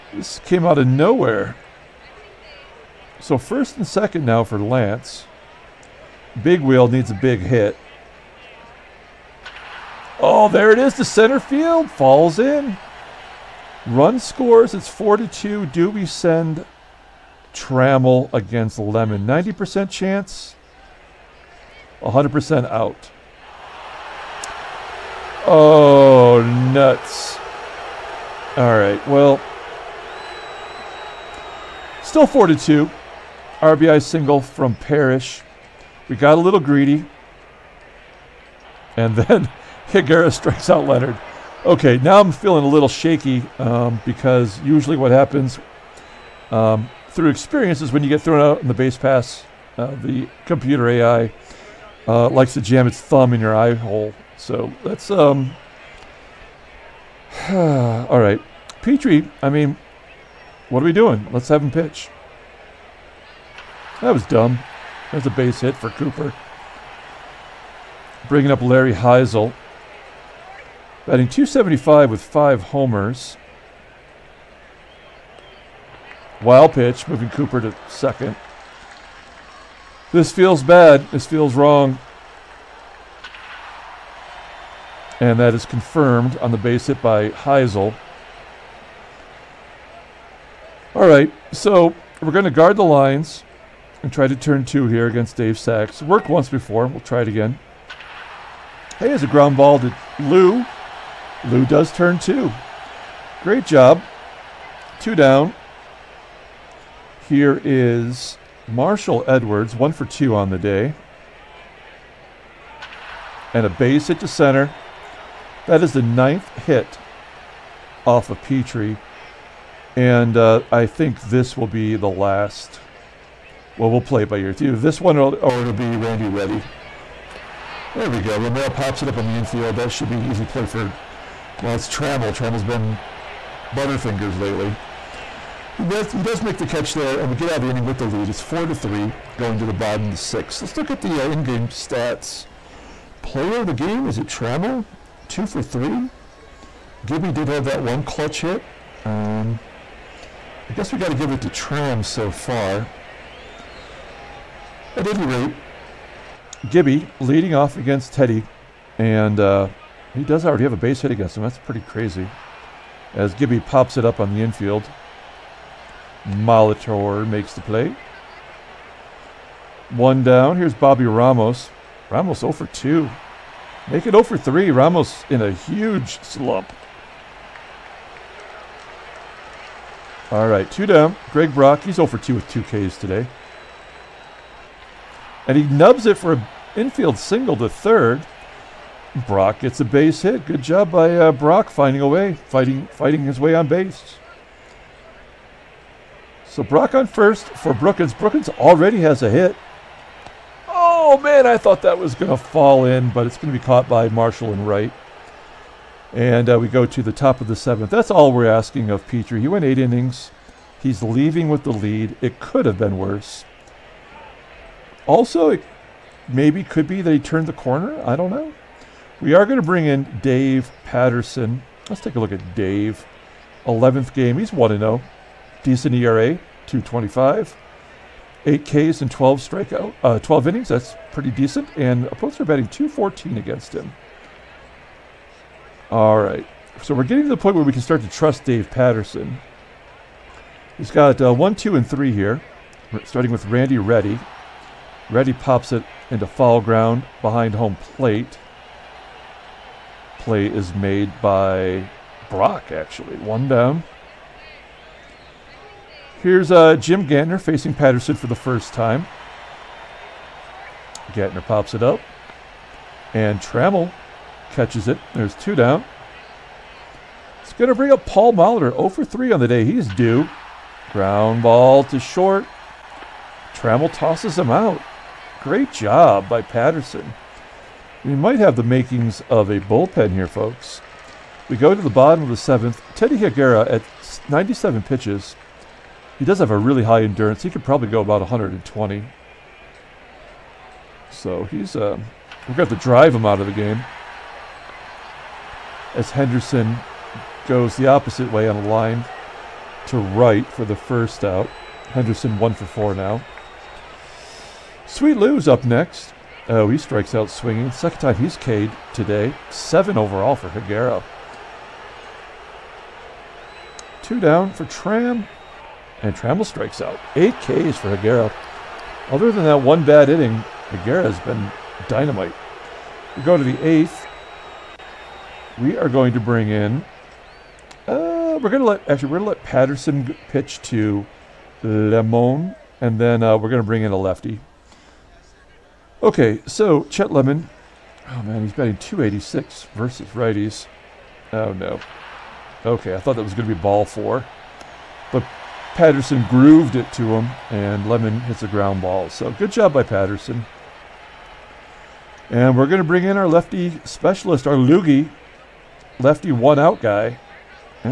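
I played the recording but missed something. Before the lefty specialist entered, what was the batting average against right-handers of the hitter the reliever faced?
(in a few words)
.286.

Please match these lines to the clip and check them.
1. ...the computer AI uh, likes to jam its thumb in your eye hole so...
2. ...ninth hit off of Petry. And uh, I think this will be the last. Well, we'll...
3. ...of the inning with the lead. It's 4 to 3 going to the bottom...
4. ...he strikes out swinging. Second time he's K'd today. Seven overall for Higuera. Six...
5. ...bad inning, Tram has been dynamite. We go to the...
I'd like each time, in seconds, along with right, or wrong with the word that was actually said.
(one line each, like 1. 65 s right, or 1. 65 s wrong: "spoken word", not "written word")
1. 49 s right
2. 116 s right
3. 137 s right
4. 306 s wrong: "Two", not "Six"
5. 319 s wrong: "Higuera", not "Tram".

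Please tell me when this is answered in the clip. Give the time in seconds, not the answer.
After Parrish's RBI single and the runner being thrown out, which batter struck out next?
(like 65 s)
40 s.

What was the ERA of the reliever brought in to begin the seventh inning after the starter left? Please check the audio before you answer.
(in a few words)
2.25.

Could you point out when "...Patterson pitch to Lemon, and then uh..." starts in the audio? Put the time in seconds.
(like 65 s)
329 s.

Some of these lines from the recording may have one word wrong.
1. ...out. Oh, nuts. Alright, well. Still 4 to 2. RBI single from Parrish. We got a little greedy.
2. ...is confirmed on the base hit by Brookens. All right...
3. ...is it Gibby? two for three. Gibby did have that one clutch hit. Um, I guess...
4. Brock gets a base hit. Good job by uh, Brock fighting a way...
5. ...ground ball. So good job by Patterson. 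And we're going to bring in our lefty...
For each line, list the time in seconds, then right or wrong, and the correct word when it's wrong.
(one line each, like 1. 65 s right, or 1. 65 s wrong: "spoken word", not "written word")
1. 22 s right
2. 85 s wrong: "Hisle", not "Brookens"
3. 144 s wrong: "Trammell", not "Gibby"
4. 189 s wrong: "finding", not "fighting"
5. 348 s right.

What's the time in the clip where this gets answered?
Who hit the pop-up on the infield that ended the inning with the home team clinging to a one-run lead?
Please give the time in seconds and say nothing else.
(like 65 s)
128 s.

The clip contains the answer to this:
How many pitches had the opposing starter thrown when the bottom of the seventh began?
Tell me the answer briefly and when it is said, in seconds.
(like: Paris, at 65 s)
97, at 284 s.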